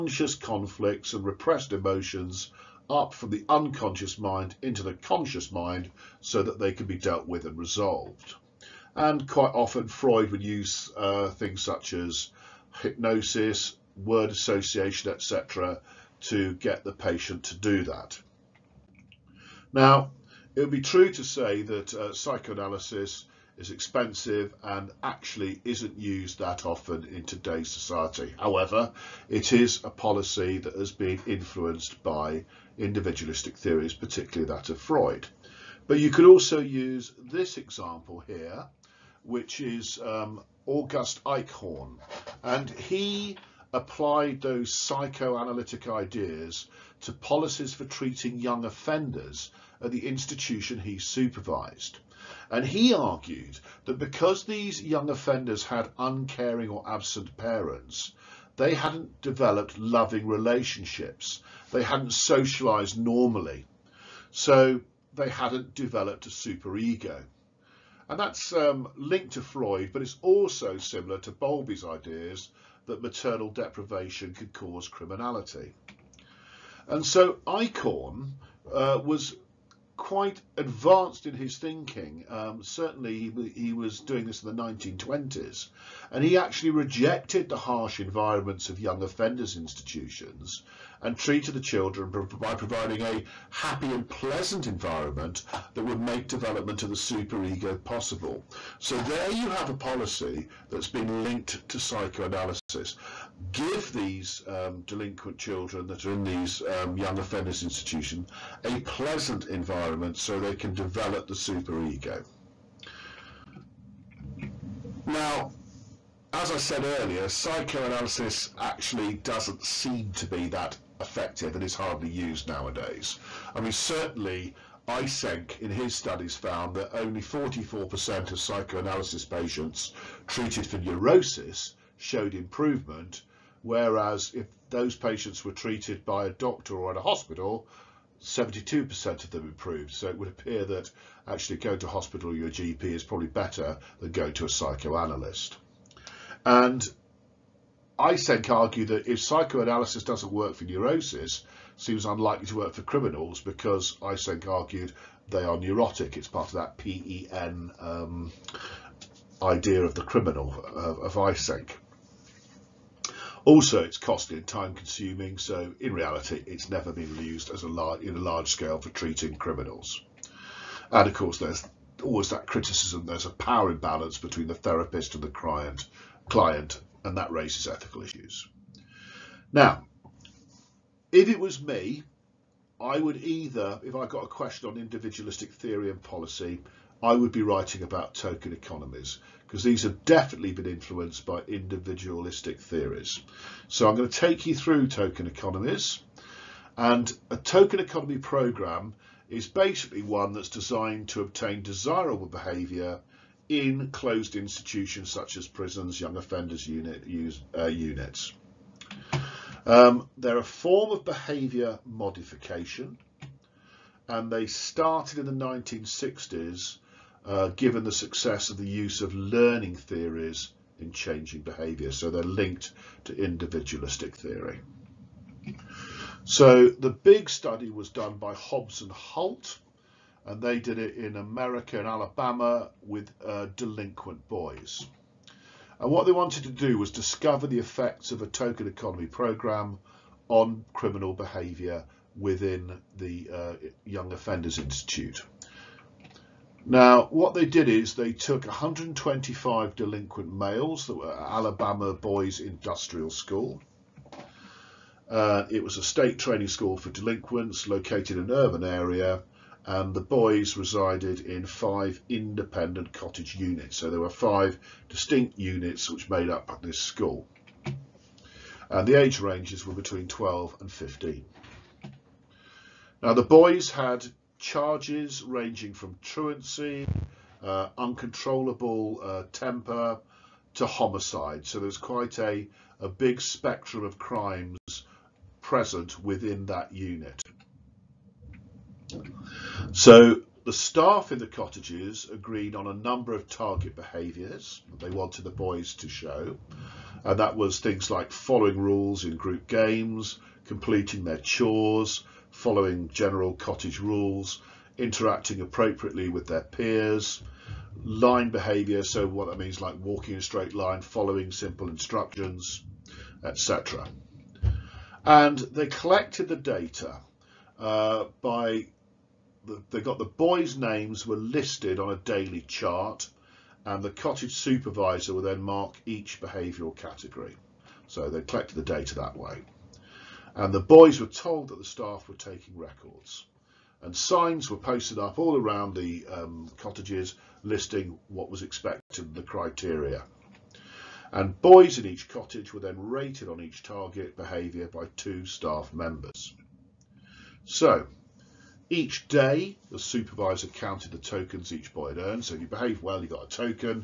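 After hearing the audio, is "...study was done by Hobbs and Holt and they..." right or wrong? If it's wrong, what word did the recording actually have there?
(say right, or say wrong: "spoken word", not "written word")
right.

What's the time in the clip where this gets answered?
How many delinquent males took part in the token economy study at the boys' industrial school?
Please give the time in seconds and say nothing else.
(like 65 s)
248 s.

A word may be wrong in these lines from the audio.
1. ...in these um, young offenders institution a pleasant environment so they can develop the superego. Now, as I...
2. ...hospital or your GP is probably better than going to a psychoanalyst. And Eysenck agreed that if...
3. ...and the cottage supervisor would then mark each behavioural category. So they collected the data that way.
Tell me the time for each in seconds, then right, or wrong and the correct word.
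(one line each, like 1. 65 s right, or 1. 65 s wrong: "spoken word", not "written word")
1. 106 s right
2. 141 s wrong: "argued", not "agreed"
3. 323 s right.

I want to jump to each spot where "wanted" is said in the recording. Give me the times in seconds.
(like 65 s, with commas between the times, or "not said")
236 s, 294 s.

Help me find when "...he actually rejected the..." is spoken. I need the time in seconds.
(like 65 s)
86 s.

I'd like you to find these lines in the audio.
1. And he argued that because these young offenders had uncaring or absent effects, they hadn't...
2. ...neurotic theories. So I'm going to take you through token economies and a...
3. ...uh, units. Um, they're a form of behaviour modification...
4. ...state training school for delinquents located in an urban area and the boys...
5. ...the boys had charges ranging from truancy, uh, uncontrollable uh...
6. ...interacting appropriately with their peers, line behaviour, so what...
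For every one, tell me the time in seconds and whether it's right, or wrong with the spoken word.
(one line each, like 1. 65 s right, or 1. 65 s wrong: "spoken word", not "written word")
1. 52 s wrong: "parents", not "effects"
2. 191 s wrong: "individualistic", not "neurotic"
3. 207 s right
4. 255 s right
5. 273 s right
6. 304 s right.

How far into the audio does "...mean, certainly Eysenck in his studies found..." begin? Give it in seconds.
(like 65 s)
123 s.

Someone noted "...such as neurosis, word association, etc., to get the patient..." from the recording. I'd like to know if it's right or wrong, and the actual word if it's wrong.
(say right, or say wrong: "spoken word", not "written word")
wrong: "hypnosis", not "neurosis".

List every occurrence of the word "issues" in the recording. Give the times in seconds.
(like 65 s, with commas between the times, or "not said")
178 s.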